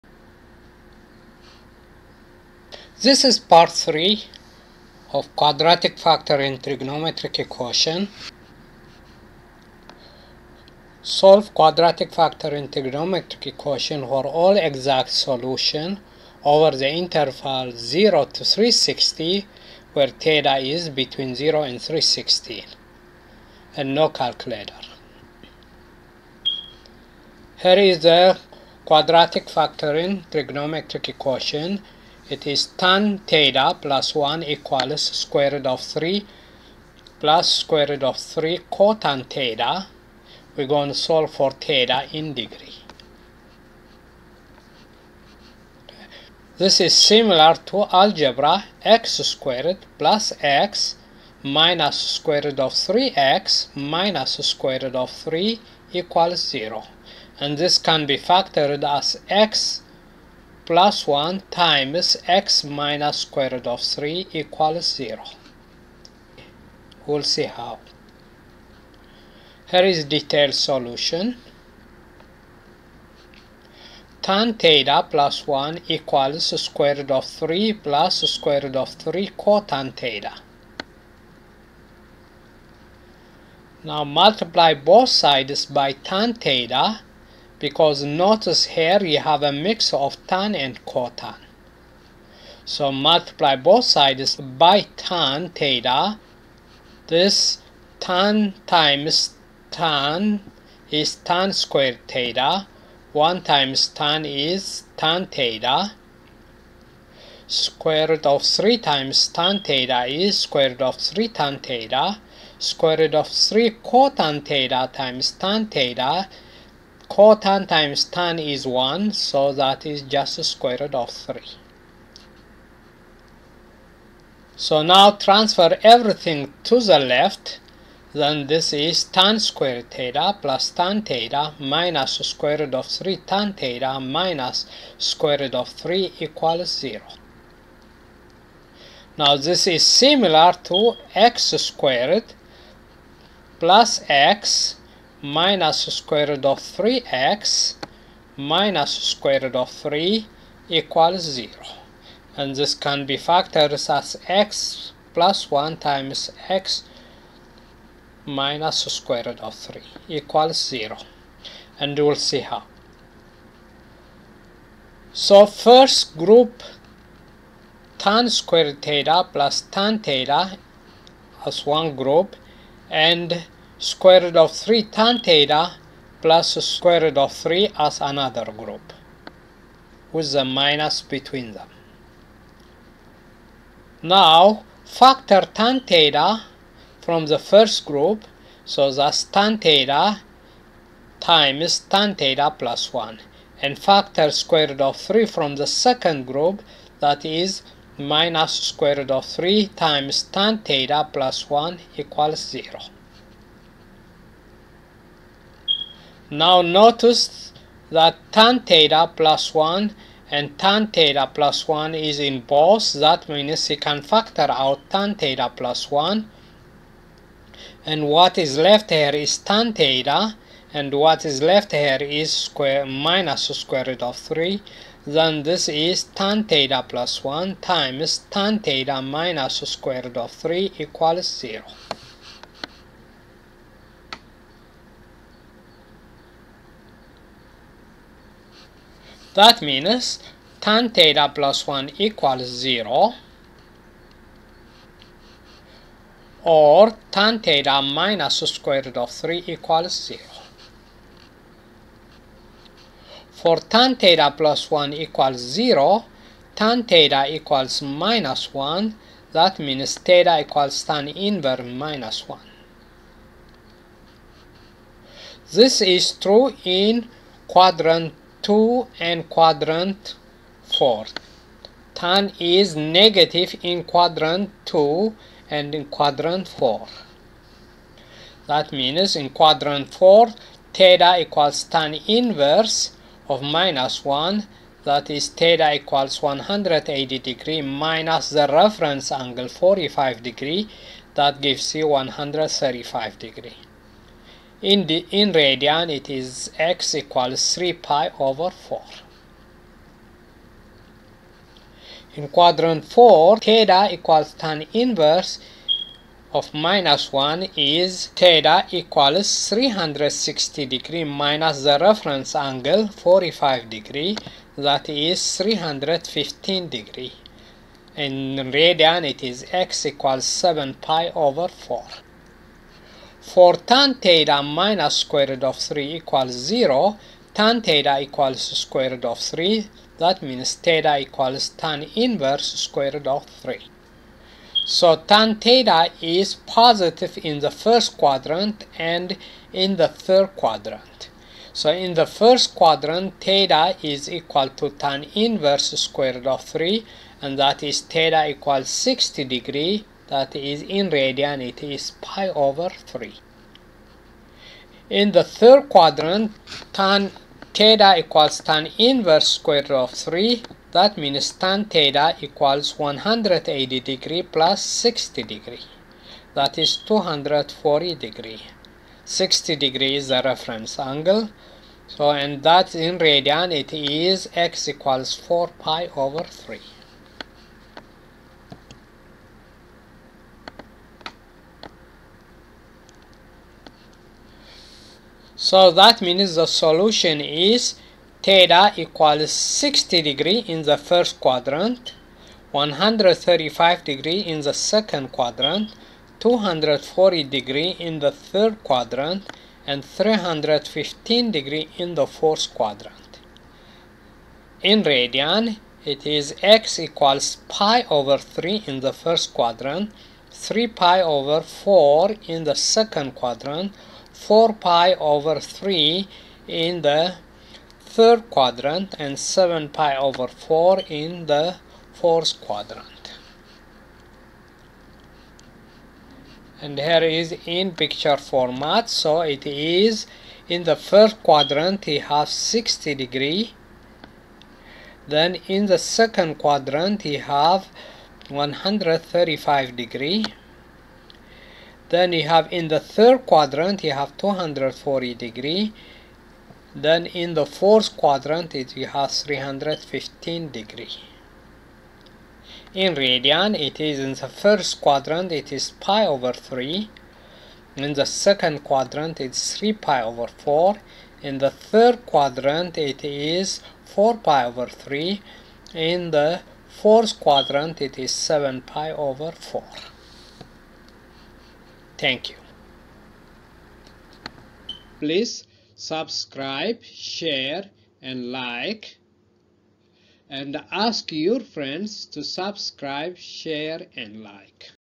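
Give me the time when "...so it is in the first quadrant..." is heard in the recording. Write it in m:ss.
7:08.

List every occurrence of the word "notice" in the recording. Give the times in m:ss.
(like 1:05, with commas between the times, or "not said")
1:28, 3:26.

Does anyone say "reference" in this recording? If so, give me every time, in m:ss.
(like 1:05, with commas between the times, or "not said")
4:48, 5:11, 6:10.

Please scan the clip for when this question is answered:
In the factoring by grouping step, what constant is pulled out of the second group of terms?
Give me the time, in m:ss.
3:13.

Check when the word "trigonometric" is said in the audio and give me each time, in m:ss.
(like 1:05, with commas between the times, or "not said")
0:06, 0:12, 0:30.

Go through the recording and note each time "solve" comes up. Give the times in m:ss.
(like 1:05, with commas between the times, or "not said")
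0:11, 0:40.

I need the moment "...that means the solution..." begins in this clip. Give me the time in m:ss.
6:25.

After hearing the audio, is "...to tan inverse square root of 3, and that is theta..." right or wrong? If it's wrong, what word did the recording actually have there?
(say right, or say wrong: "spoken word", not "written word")
right.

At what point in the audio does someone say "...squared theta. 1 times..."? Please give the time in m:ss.
1:41.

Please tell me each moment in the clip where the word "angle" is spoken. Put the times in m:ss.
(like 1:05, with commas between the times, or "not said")
4:49, 5:12, 6:10.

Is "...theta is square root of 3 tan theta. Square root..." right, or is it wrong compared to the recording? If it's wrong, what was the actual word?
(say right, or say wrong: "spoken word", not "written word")
right.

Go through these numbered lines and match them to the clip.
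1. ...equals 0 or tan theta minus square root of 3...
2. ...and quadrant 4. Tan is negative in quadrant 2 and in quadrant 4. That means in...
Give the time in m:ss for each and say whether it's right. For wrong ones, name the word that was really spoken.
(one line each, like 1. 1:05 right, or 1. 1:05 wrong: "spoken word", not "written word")
1. 4:01 right
2. 4:28 right.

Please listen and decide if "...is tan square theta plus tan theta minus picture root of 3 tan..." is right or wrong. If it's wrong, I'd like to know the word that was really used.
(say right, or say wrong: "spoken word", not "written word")
wrong: "square", not "picture".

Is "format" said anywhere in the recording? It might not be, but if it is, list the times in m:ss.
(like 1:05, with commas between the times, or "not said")
7:08.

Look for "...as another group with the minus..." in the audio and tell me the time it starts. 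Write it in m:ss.
2:57.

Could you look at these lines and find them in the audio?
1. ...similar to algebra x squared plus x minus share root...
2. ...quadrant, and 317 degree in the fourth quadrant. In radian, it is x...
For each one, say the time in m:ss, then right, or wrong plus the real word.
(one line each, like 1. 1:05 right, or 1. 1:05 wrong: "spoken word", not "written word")
1. 0:46 wrong: "square", not "share"
2. 6:38 wrong: "315", not "317".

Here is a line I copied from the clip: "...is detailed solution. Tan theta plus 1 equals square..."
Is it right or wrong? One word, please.
right.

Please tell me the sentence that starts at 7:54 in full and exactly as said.
Please subscribe, share and like and ask your friends to subscribe, share and like.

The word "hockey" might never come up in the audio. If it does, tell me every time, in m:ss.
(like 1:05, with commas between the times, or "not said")
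not said.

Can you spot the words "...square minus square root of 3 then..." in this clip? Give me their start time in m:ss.
3:42.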